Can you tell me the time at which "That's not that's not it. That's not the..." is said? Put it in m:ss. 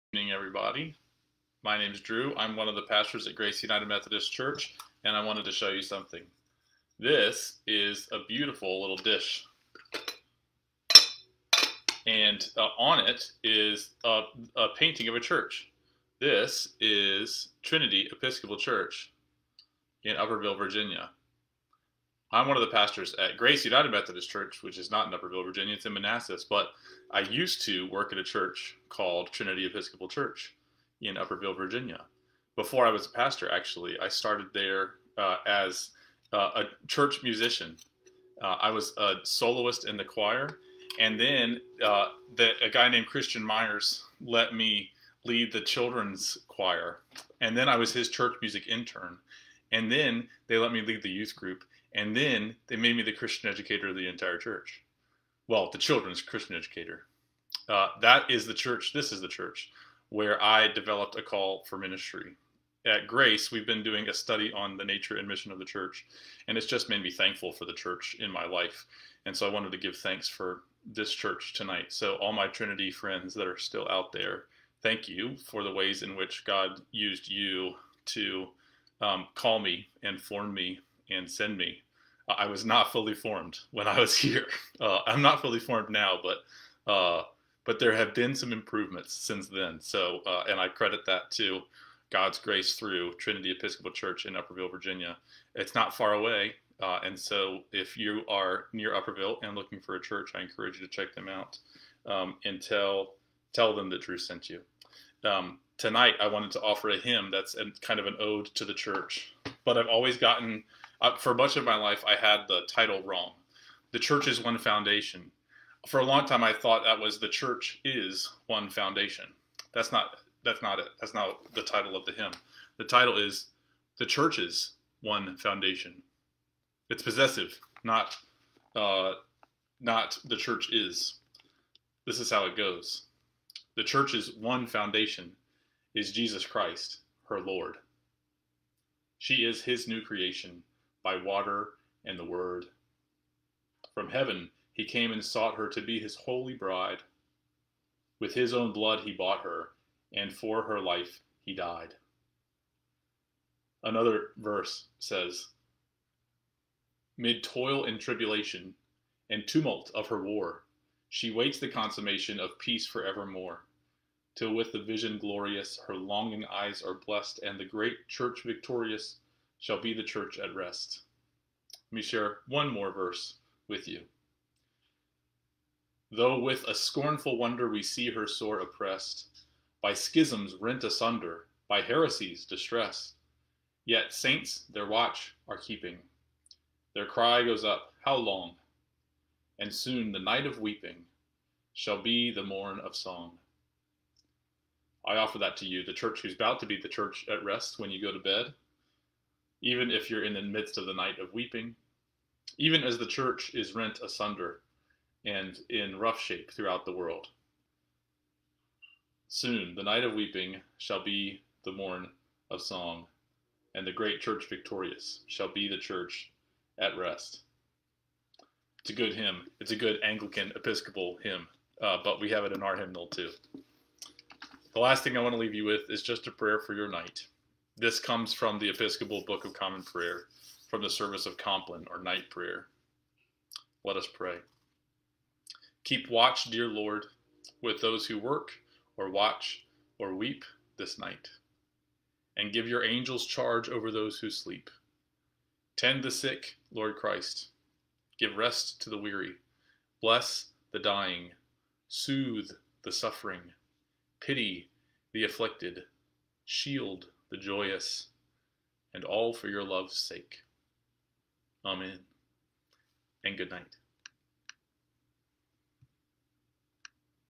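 1:59.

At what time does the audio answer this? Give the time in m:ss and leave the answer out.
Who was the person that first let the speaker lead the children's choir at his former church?
0:43.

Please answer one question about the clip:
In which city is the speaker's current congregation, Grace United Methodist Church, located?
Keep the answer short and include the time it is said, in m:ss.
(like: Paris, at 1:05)
Manassas, at 0:25.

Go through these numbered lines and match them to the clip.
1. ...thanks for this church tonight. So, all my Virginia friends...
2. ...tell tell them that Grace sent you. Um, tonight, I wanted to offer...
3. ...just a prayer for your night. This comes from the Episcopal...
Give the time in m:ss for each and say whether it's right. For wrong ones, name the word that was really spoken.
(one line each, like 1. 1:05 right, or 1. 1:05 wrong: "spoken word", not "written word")
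1. 1:09 wrong: "Trinity", not "Virginia"
2. 1:42 wrong: "Drew", not "Grace"
3. 3:46 right.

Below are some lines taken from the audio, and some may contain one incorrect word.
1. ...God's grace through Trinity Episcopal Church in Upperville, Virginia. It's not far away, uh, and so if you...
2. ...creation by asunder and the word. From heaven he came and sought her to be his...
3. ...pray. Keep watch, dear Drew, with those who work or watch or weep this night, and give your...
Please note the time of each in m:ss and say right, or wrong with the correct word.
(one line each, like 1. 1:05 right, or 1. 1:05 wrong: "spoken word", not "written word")
1. 1:32 right
2. 2:20 wrong: "water", not "asunder"
3. 3:54 wrong: "Lord", not "Drew".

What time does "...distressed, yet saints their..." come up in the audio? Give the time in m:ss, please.
3:02.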